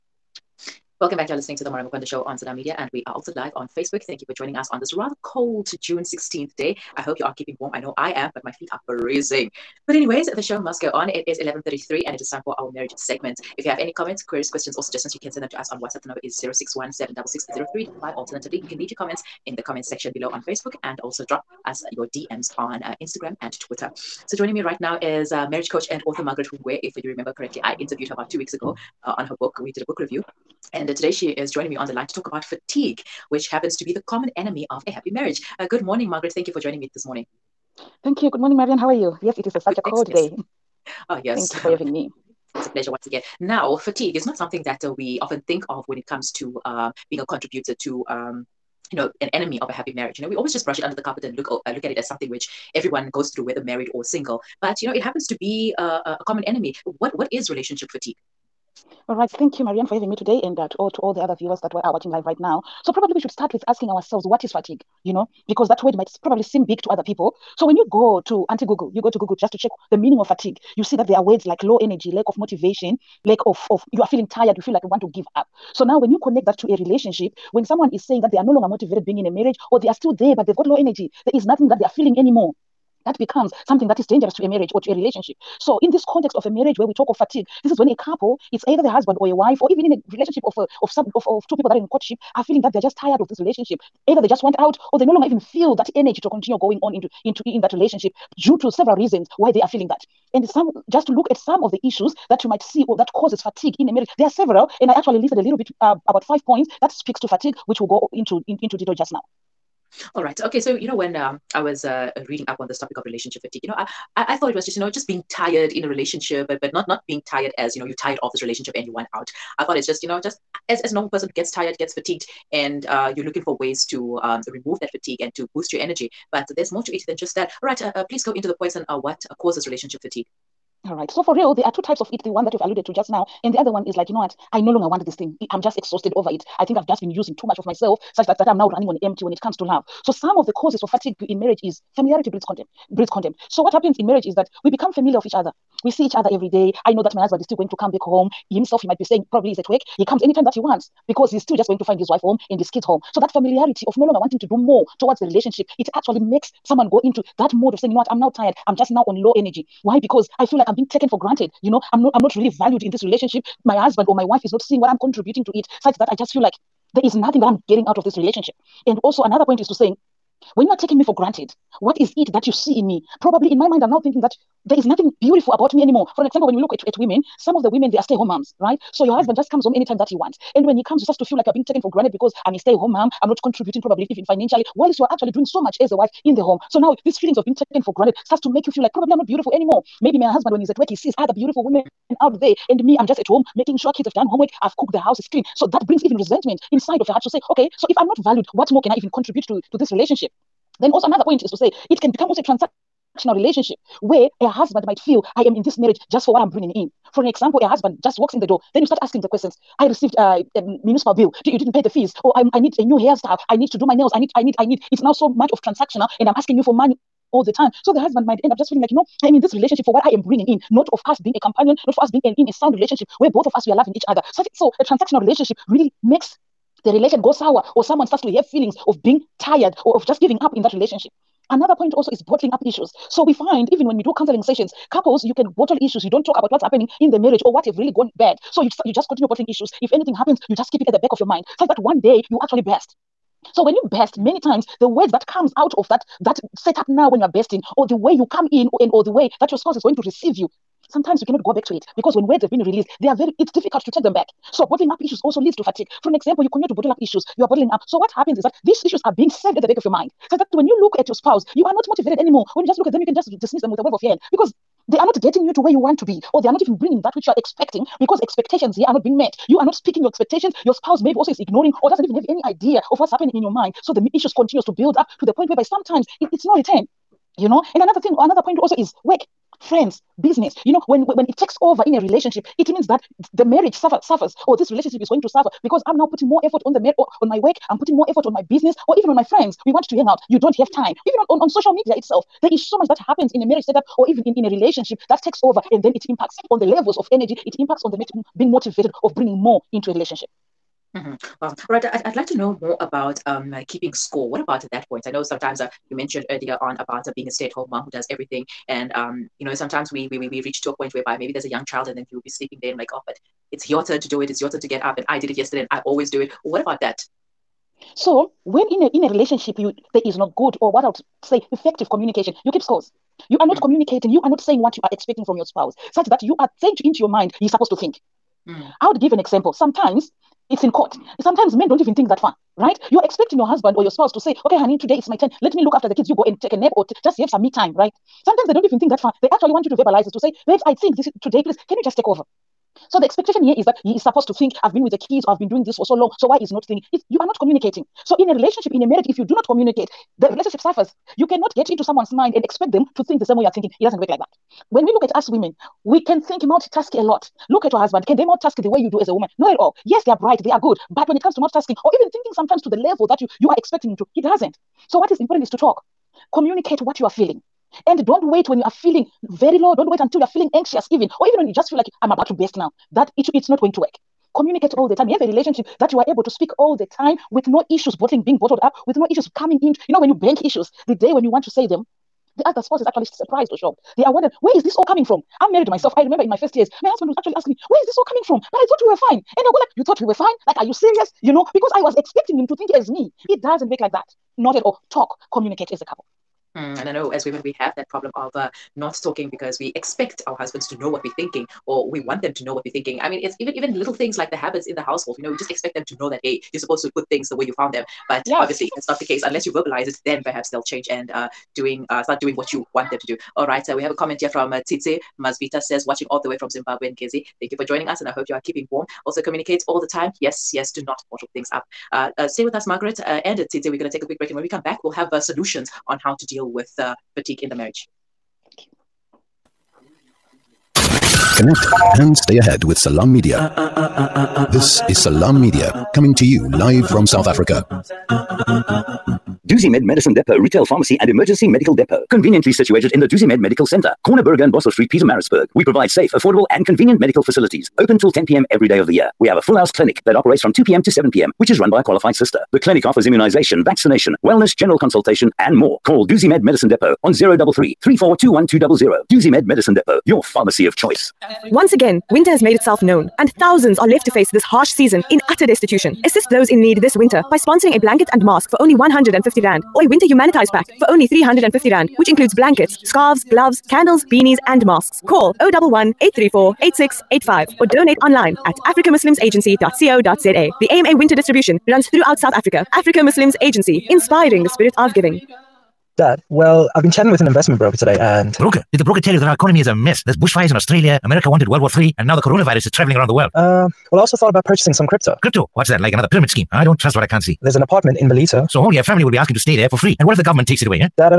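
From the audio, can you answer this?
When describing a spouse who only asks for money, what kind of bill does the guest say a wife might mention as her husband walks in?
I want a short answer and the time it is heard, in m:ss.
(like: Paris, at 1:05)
municipal bill, at 3:30.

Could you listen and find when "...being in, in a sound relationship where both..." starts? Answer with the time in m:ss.
3:42.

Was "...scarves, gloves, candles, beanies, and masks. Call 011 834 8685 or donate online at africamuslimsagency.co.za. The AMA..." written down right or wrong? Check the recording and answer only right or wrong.
right.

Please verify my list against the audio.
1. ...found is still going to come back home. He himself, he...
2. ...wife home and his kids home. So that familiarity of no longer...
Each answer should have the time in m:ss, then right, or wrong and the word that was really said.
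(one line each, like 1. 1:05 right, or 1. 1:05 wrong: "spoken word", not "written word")
1. 2:27 wrong: "husband", not "found"
2. 2:32 right.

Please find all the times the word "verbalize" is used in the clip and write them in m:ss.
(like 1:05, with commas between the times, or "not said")
5:39, 6:49.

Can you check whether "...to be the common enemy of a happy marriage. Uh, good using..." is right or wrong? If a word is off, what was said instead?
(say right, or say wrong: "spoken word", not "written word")
wrong: "morning", not "using".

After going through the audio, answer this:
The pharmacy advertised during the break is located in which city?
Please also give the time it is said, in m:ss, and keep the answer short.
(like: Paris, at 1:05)
Pietermaritzburg, at 7:24.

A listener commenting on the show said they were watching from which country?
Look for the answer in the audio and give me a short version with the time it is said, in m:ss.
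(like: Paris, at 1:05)
Zimbabwe, at 6:56.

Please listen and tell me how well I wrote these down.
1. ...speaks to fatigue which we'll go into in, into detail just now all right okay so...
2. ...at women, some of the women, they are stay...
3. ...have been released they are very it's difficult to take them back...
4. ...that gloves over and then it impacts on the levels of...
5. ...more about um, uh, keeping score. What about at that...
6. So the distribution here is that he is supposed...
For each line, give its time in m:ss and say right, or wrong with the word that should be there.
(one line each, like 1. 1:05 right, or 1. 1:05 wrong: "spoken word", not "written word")
1. 1:46 right
2. 2:56 right
3. 4:12 right
4. 4:55 wrong: "takes", not "gloves"
5. 5:02 right
6. 5:42 wrong: "expectation", not "distribution".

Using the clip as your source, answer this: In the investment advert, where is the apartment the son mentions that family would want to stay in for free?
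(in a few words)
Ballito.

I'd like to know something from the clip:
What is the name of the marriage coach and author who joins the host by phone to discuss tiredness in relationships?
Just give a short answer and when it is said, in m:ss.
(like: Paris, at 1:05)
Margaret Hungwe, at 0:26.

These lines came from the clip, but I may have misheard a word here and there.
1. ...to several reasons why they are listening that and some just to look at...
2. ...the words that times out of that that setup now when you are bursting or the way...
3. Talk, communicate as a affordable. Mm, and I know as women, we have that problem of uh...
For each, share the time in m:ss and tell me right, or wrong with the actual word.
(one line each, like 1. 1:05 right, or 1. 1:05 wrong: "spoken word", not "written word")
1. 1:38 wrong: "feeling", not "listening"
2. 4:04 wrong: "comes", not "times"
3. 6:34 wrong: "couple", not "affordable".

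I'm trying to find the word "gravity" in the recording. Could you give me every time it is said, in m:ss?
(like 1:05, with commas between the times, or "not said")
not said.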